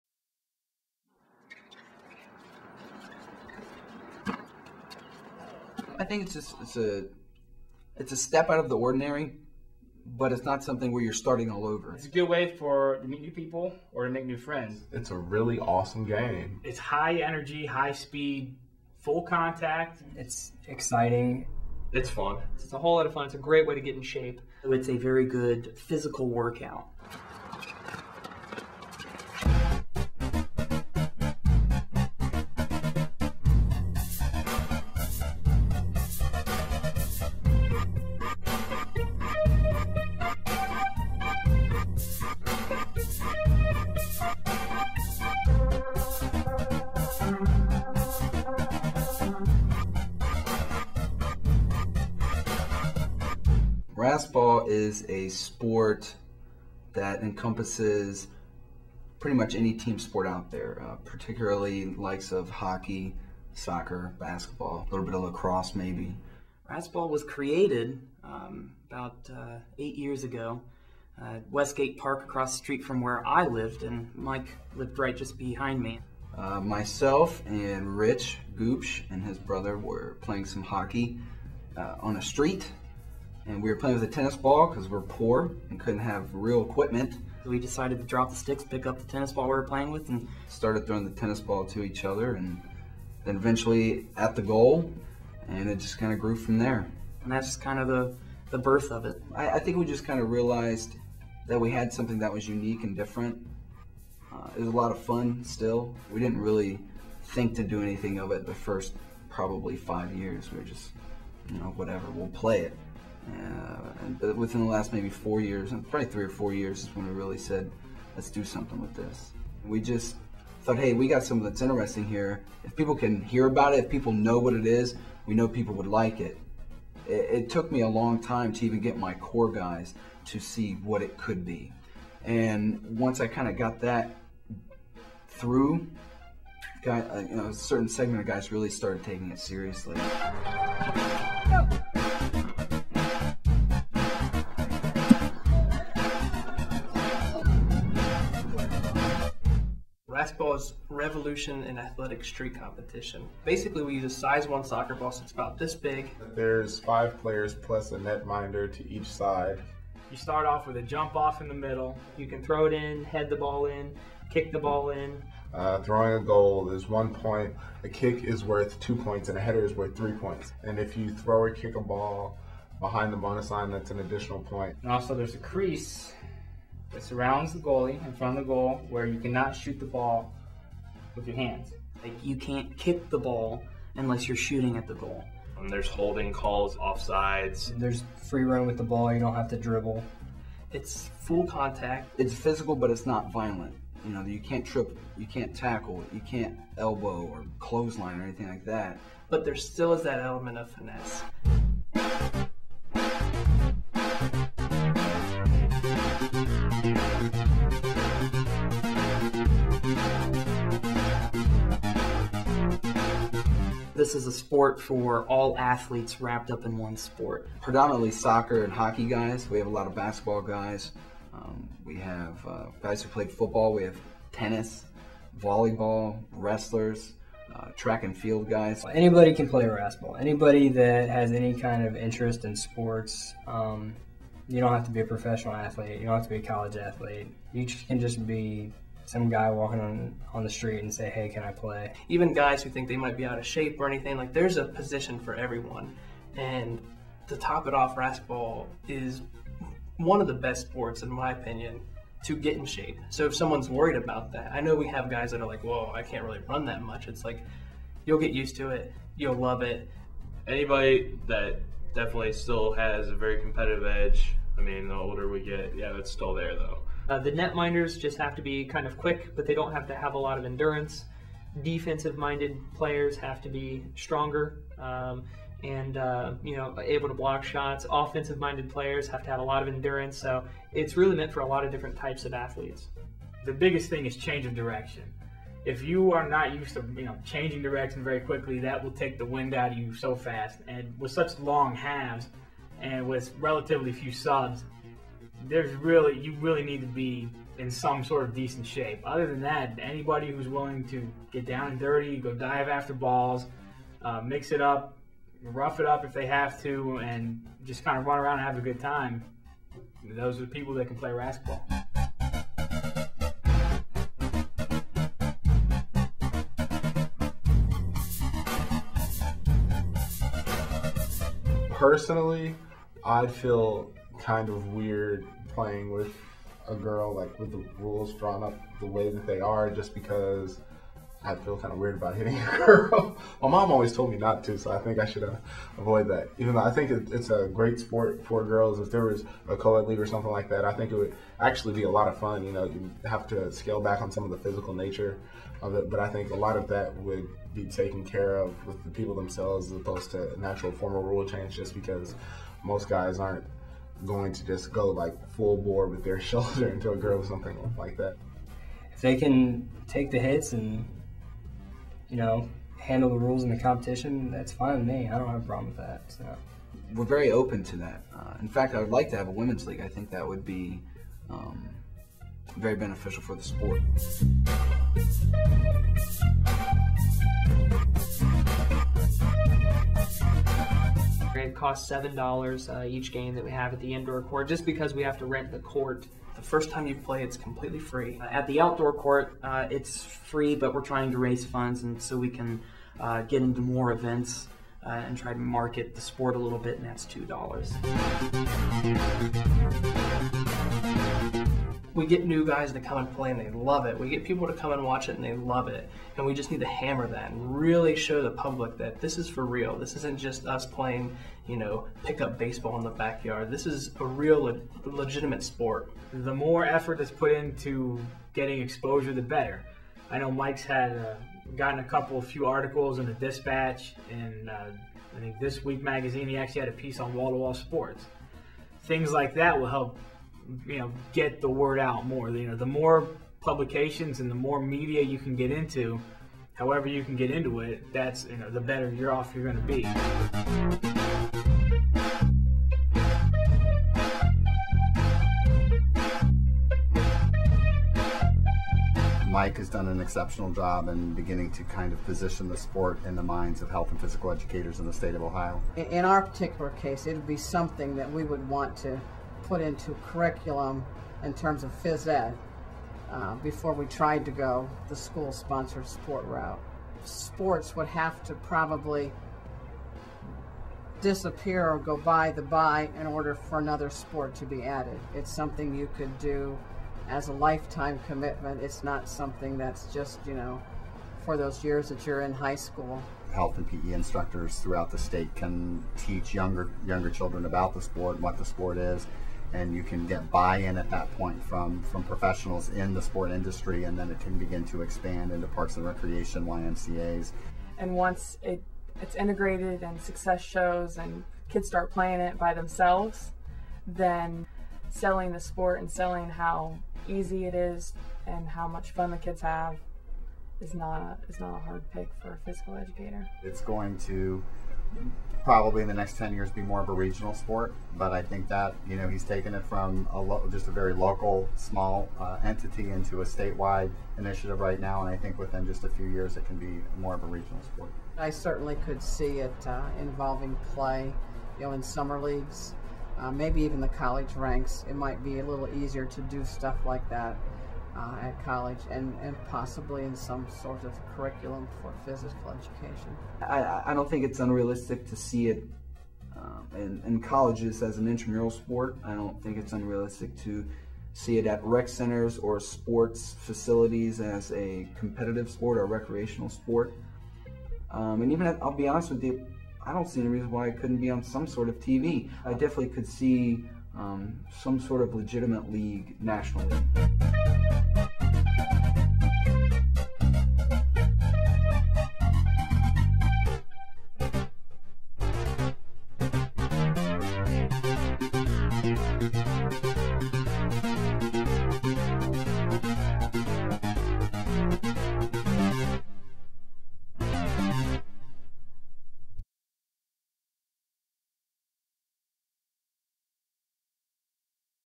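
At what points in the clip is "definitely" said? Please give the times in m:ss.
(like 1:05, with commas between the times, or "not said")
4:21, 9:22.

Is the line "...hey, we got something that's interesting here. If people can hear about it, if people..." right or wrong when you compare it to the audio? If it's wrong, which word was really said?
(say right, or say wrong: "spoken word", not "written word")
right.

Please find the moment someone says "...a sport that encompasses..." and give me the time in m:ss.
0:55.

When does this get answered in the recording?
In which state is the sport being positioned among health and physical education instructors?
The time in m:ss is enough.
7:35.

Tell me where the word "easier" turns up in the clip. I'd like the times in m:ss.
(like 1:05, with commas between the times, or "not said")
8:55.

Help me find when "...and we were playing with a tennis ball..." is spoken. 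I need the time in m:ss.
1:23.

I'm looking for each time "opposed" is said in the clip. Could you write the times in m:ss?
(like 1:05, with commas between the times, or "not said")
5:49.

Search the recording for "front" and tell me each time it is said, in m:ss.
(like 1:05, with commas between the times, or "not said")
2:58.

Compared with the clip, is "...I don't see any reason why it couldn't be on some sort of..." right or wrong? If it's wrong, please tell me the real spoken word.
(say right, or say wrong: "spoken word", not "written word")
right.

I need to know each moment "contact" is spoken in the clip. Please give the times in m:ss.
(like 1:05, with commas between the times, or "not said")
0:19, 3:11.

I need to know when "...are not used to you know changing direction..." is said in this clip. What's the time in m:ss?
4:46.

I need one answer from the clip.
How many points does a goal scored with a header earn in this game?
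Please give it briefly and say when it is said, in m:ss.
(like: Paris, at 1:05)
3, at 2:49.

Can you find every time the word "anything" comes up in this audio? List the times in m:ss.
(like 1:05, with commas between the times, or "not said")
1:47, 3:18, 4:03.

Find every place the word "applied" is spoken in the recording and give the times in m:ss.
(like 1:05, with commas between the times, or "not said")
not said.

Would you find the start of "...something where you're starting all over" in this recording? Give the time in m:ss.
0:10.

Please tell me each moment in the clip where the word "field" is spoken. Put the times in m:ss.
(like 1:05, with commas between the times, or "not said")
3:48.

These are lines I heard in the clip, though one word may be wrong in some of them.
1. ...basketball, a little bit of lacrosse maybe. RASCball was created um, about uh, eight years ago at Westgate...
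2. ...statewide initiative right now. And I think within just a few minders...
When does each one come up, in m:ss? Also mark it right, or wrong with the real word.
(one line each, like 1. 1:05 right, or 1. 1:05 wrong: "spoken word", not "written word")
1. 1:04 right
2. 8:43 wrong: "years", not "minders".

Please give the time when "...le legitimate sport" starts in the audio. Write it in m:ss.
6:54.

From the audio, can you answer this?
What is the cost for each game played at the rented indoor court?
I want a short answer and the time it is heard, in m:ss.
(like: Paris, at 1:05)
$7, at 6:21.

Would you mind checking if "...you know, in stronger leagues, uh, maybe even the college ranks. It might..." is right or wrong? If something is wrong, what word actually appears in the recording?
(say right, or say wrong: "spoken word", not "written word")
wrong: "summer", not "stronger".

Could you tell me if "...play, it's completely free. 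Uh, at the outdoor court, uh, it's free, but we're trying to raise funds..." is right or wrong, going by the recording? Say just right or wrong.
right.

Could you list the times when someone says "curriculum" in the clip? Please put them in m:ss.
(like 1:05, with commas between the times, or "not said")
7:40, 9:01.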